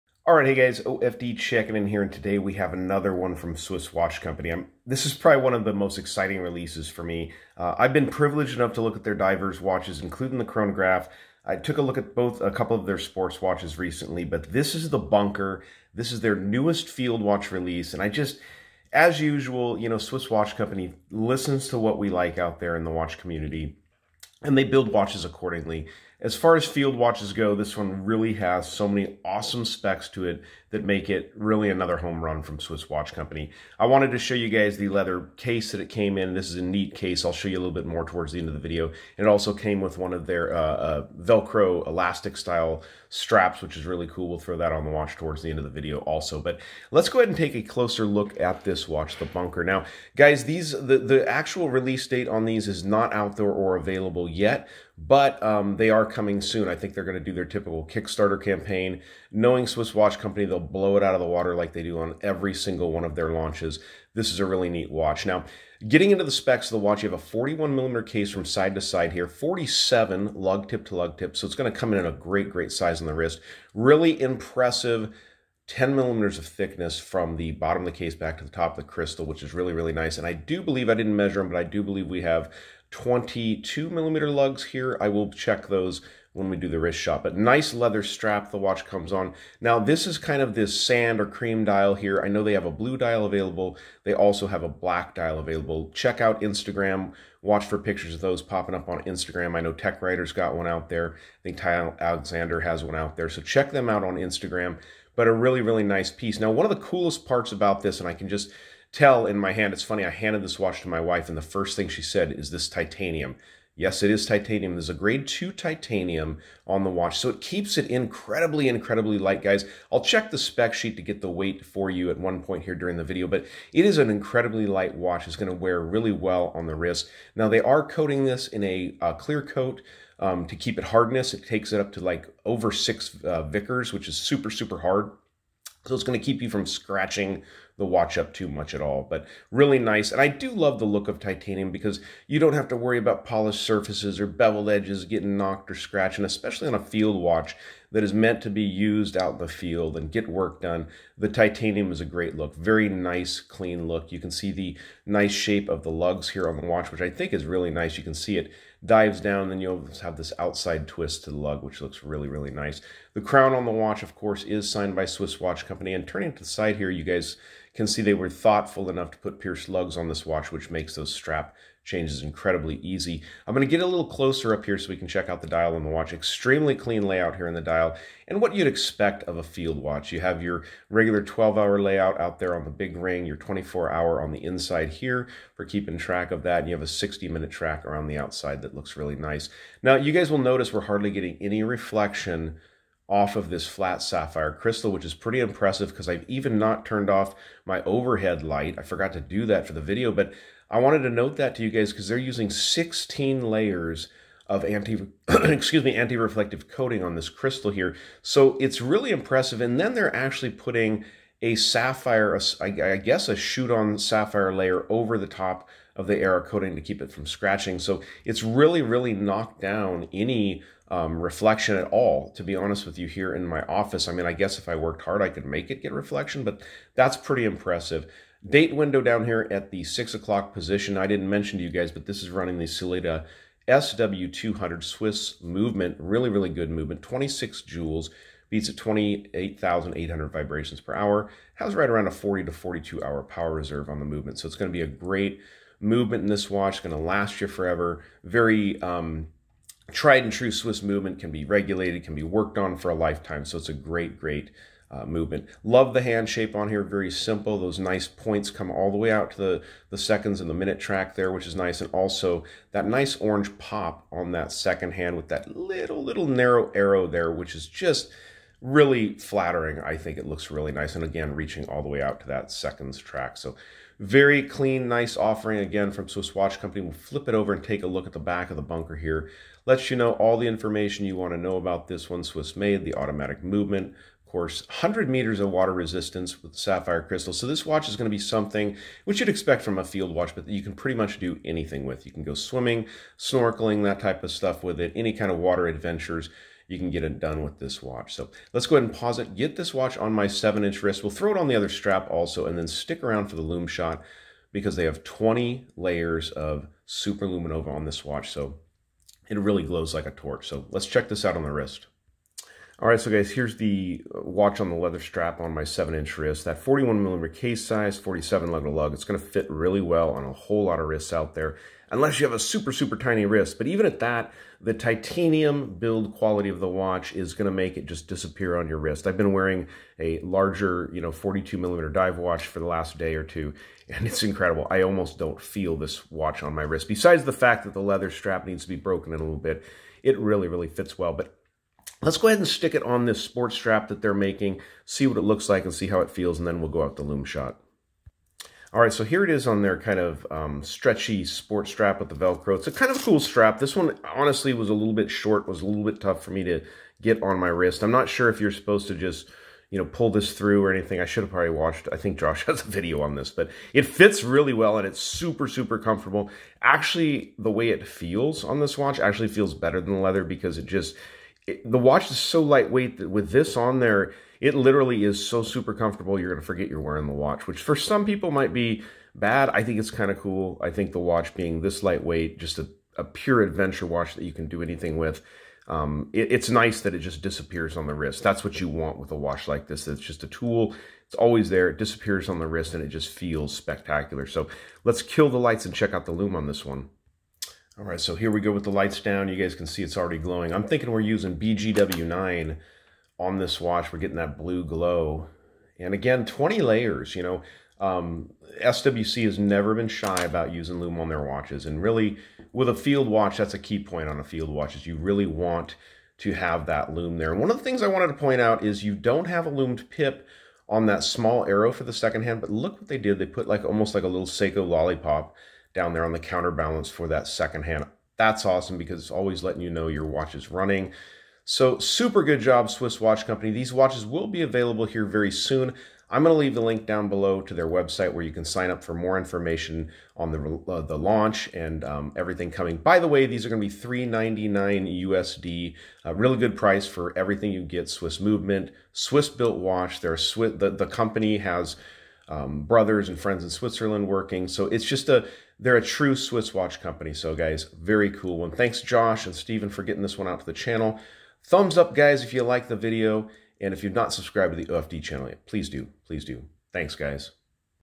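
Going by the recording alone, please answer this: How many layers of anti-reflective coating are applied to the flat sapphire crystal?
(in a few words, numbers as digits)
16.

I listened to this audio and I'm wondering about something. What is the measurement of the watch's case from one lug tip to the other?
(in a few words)
47 millimeters.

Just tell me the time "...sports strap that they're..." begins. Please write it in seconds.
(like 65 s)
343 s.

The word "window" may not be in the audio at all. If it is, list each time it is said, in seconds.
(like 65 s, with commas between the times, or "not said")
228 s.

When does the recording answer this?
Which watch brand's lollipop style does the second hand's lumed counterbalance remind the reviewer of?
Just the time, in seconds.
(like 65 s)
424 s.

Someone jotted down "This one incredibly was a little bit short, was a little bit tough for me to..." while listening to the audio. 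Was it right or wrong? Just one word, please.
wrong.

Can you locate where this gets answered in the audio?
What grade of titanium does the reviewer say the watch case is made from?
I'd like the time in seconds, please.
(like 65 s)
114 s.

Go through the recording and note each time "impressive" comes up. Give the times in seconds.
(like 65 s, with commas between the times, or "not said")
74 s, 195 s, 209 s, 227 s.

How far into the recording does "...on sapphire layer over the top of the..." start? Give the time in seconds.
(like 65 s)
213 s.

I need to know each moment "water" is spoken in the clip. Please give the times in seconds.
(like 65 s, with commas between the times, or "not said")
61 s, 285 s, 295 s.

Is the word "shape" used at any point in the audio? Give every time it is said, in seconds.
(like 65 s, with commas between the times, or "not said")
155 s, 256 s.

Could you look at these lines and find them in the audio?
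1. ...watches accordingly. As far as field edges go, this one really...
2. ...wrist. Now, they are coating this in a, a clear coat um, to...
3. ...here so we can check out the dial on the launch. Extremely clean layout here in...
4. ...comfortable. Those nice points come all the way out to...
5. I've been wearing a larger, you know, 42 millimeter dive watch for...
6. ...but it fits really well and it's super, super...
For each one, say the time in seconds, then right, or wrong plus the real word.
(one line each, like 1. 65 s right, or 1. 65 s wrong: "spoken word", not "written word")
1. 24 s wrong: "watches", not "edges"
2. 126 s right
3. 174 s wrong: "watch", not "launch"
4. 257 s wrong: "simple", not "comfortable"
5. 329 s right
6. 363 s right.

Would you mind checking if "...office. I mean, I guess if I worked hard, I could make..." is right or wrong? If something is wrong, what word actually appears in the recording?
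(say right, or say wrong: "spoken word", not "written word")
right.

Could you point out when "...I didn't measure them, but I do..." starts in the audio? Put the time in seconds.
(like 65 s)
80 s.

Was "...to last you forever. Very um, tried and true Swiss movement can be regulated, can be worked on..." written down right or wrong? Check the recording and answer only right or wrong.
right.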